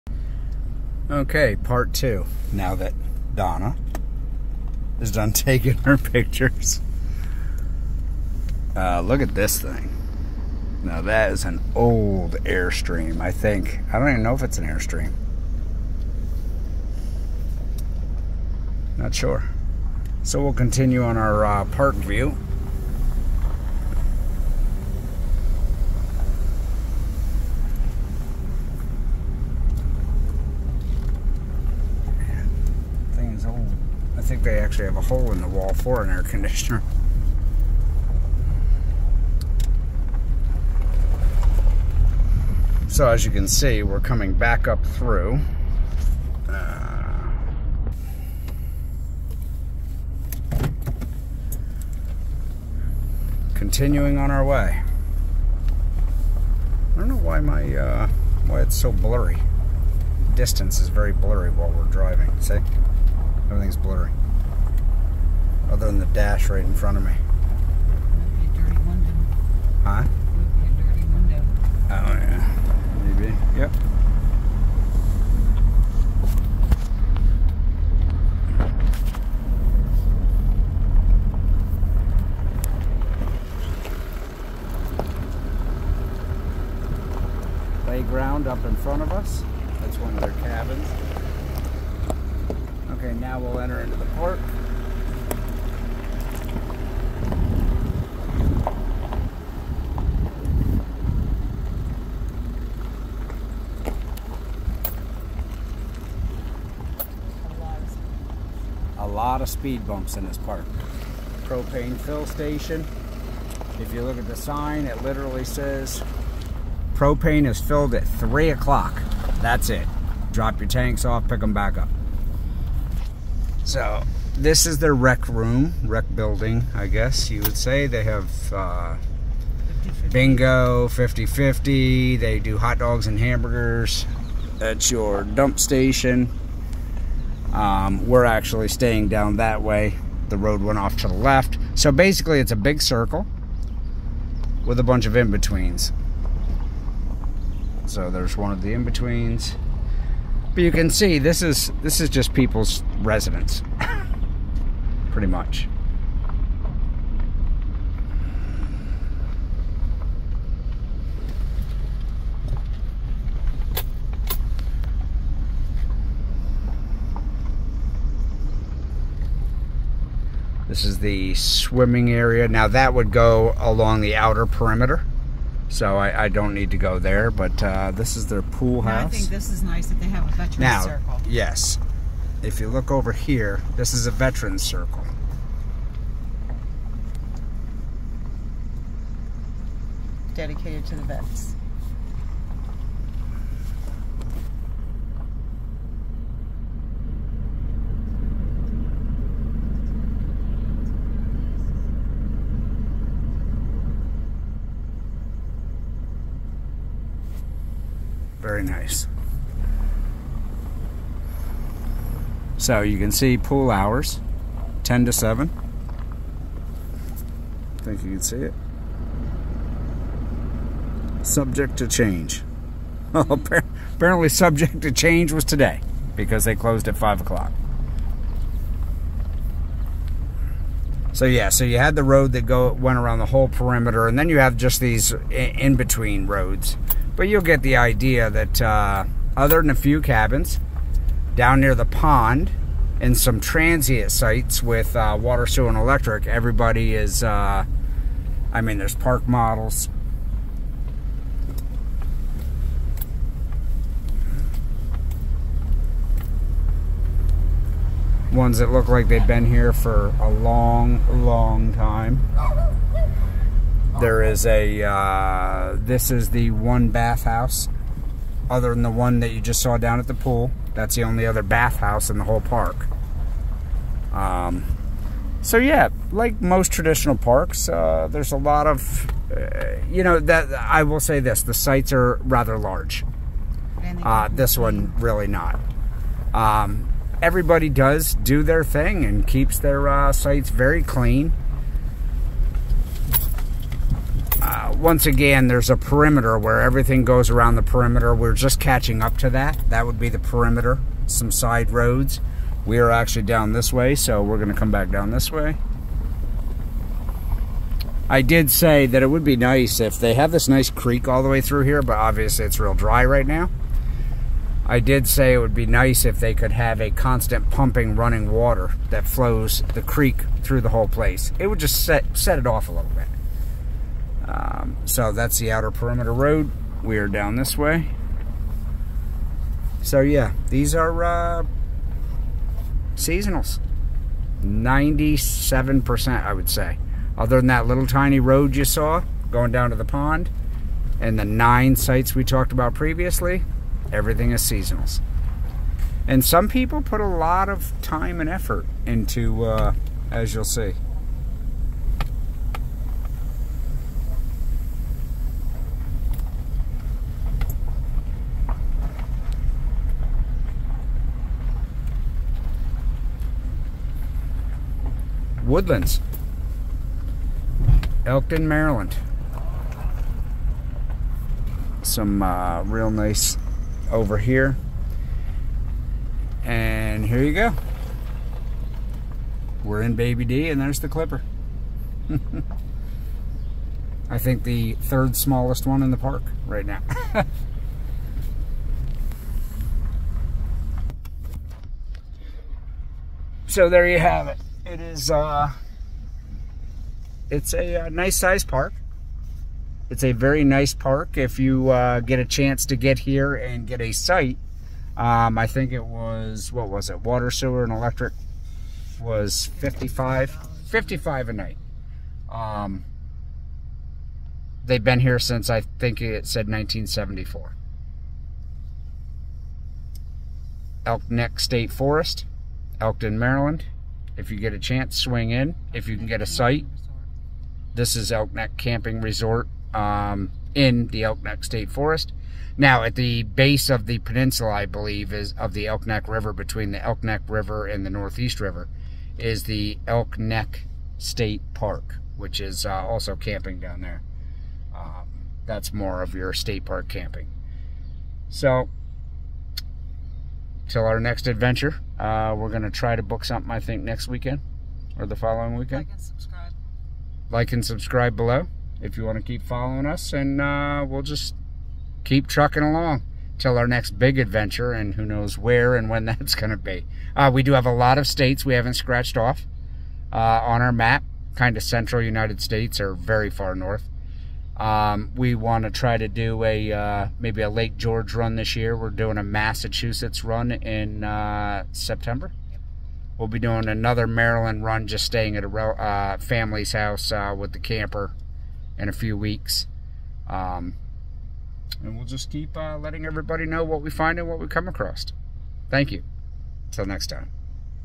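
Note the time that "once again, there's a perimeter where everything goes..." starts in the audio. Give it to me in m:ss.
4:54.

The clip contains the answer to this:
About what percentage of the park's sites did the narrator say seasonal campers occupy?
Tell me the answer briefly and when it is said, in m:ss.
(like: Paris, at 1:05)
97%, at 5:34.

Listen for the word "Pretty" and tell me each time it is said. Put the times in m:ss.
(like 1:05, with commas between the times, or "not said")
2:35.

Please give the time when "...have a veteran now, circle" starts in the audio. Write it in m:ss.
3:00.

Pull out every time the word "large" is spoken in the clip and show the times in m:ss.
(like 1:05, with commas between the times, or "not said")
4:42.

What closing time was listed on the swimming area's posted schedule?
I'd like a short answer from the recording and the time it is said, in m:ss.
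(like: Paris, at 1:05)
7, at 3:34.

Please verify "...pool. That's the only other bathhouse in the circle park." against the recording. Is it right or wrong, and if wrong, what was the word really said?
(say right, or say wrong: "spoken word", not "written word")
wrong: "whole", not "circle".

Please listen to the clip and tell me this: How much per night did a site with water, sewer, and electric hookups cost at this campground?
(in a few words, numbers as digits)
$55.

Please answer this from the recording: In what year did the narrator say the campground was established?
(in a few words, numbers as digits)
1974.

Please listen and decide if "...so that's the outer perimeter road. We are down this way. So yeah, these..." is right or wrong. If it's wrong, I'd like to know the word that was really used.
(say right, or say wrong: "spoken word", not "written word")
right.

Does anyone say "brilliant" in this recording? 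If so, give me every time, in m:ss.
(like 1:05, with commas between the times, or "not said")
not said.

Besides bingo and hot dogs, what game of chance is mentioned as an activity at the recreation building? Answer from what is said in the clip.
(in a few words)
50-50.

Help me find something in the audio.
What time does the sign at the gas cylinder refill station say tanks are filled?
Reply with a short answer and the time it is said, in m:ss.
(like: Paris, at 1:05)
3 o'clock, at 1:58.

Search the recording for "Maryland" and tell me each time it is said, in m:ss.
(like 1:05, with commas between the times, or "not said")
6:08, 7:03, 8:04.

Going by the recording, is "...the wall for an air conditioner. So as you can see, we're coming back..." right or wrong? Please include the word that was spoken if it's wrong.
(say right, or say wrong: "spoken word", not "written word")
right.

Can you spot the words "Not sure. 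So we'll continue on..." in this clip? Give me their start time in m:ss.
0:18.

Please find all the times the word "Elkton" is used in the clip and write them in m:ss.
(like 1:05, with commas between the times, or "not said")
6:08, 7:02.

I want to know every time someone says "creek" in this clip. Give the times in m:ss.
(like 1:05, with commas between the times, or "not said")
5:10, 5:19.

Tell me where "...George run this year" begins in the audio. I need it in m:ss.
7:57.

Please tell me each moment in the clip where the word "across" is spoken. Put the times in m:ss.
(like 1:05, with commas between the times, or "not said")
8:14.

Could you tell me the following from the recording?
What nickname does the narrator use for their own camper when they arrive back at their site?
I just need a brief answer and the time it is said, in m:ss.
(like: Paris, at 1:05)
Baby D, at 6:19.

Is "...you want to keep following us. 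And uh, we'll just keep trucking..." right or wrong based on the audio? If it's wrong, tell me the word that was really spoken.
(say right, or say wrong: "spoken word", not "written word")
right.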